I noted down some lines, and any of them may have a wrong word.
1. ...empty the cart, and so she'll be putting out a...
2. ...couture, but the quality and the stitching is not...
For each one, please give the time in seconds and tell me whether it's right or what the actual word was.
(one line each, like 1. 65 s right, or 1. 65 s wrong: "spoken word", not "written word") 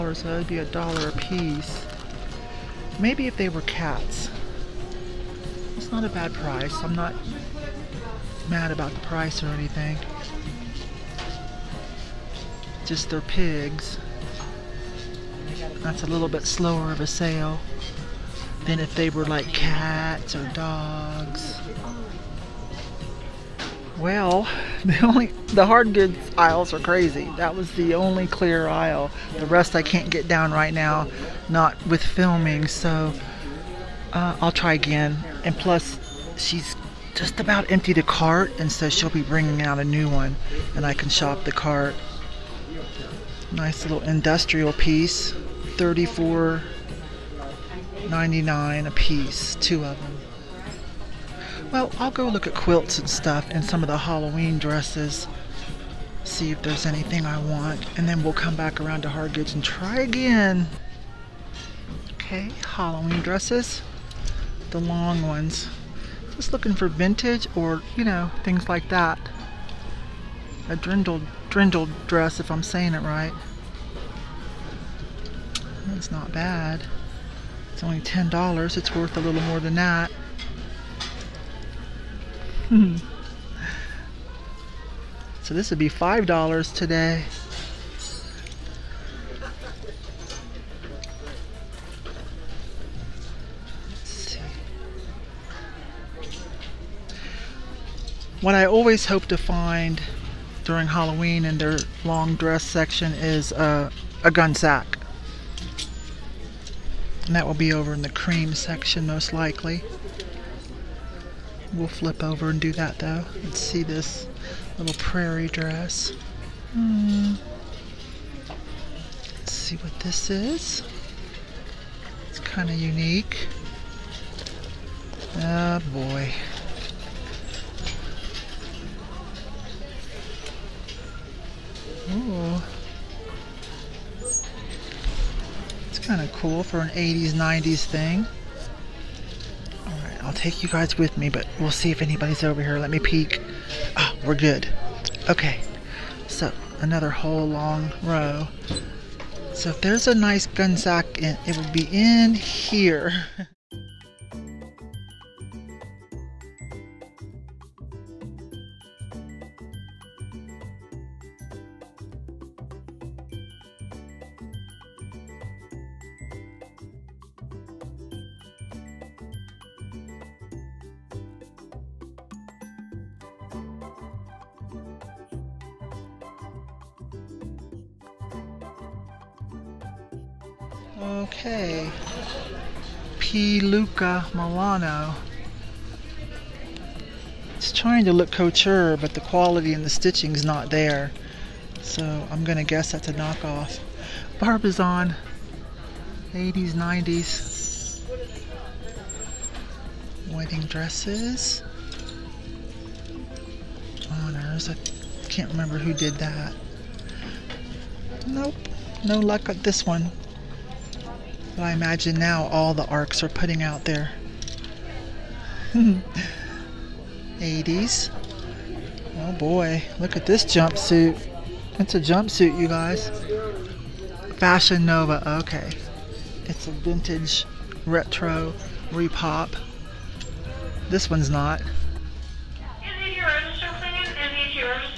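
1. 37 s wrong: "bringing", not "putting"
2. 188 s right.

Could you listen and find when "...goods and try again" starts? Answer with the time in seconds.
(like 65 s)
59 s.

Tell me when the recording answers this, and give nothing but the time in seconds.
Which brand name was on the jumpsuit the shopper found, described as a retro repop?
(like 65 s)
224 s.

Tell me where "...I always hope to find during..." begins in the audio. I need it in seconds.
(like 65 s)
98 s.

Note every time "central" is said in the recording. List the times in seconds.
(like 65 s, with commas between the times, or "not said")
not said.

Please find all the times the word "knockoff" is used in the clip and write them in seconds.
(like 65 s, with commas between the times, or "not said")
193 s.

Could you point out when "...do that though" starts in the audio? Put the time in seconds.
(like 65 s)
112 s.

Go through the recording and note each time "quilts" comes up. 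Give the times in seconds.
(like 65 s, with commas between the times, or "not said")
52 s.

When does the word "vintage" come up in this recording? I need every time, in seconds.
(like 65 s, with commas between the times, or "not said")
66 s, 226 s.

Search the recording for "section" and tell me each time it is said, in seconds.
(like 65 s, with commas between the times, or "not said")
102 s, 108 s.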